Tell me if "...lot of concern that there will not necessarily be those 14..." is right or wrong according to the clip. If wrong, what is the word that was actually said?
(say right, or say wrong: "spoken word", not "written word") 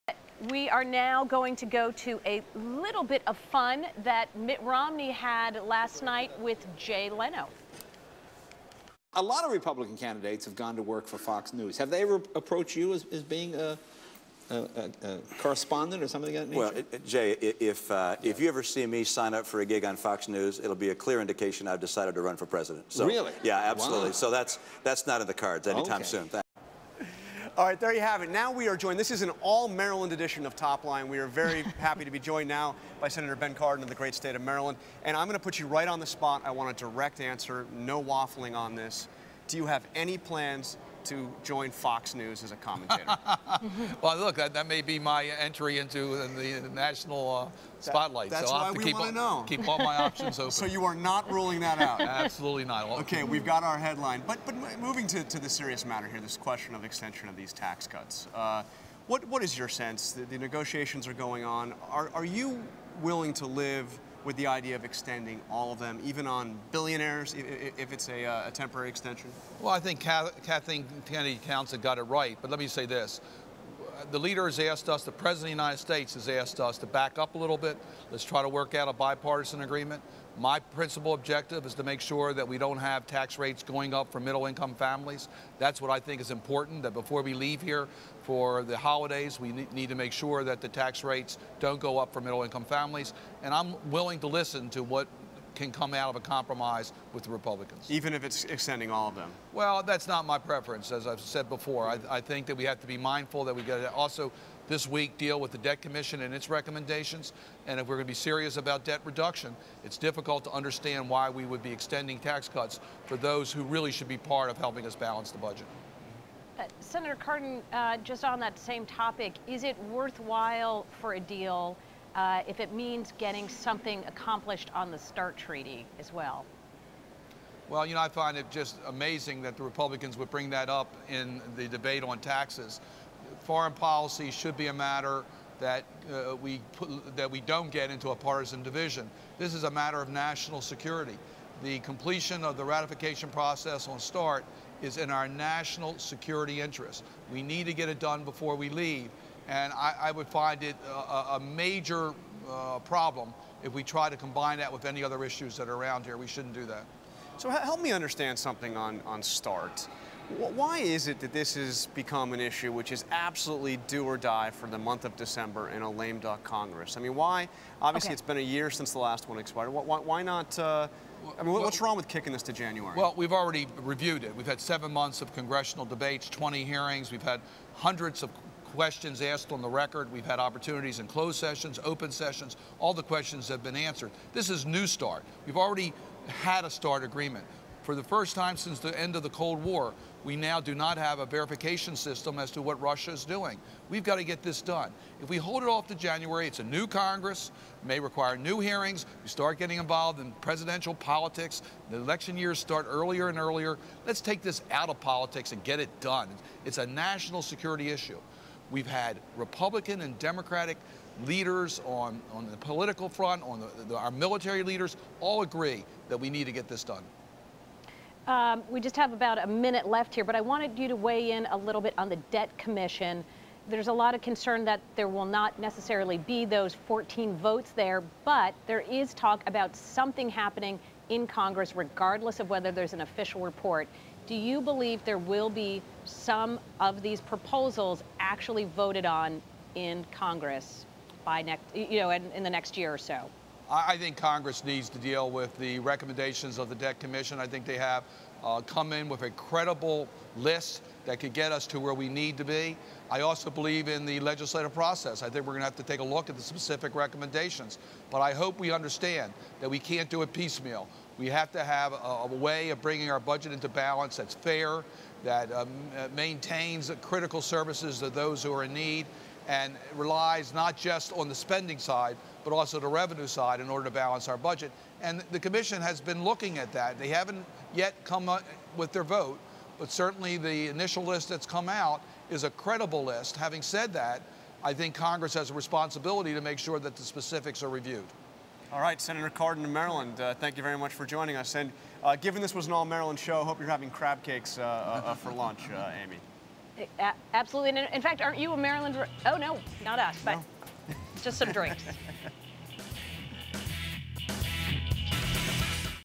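right.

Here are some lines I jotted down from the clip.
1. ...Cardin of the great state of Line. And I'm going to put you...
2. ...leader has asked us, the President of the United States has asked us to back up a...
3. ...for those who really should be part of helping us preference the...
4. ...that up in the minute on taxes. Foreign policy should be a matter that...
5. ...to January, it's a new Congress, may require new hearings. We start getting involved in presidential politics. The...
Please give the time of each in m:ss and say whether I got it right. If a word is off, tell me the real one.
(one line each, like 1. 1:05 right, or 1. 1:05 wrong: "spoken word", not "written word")
1. 0:33 wrong: "Maryland", not "Line"
2. 1:14 right
3. 1:53 wrong: "balance", not "preference"
4. 2:10 wrong: "debate", not "minute"
5. 3:15 right.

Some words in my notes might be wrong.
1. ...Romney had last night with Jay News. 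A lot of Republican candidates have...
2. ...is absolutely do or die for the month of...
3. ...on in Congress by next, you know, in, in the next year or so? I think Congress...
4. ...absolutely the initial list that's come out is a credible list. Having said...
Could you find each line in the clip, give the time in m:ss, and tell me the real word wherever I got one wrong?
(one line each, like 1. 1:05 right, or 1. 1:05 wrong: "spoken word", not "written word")
1. 0:04 wrong: "Leno", not "News"
2. 2:42 right
3. 3:59 right
4. 4:39 wrong: "certainly", not "absolutely".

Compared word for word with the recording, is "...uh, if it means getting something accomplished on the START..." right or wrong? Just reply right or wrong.
right.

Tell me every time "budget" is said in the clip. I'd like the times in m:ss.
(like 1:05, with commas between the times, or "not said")
1:55, 4:23, 4:34.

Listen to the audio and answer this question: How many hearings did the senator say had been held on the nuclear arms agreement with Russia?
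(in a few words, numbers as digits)
20.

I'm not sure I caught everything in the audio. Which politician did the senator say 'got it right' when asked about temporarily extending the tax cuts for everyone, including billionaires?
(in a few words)
Kathleen Kennedy Townsend.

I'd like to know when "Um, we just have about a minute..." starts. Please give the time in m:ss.
3:38.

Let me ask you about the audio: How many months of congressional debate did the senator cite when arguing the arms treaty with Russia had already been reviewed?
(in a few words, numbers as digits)
7.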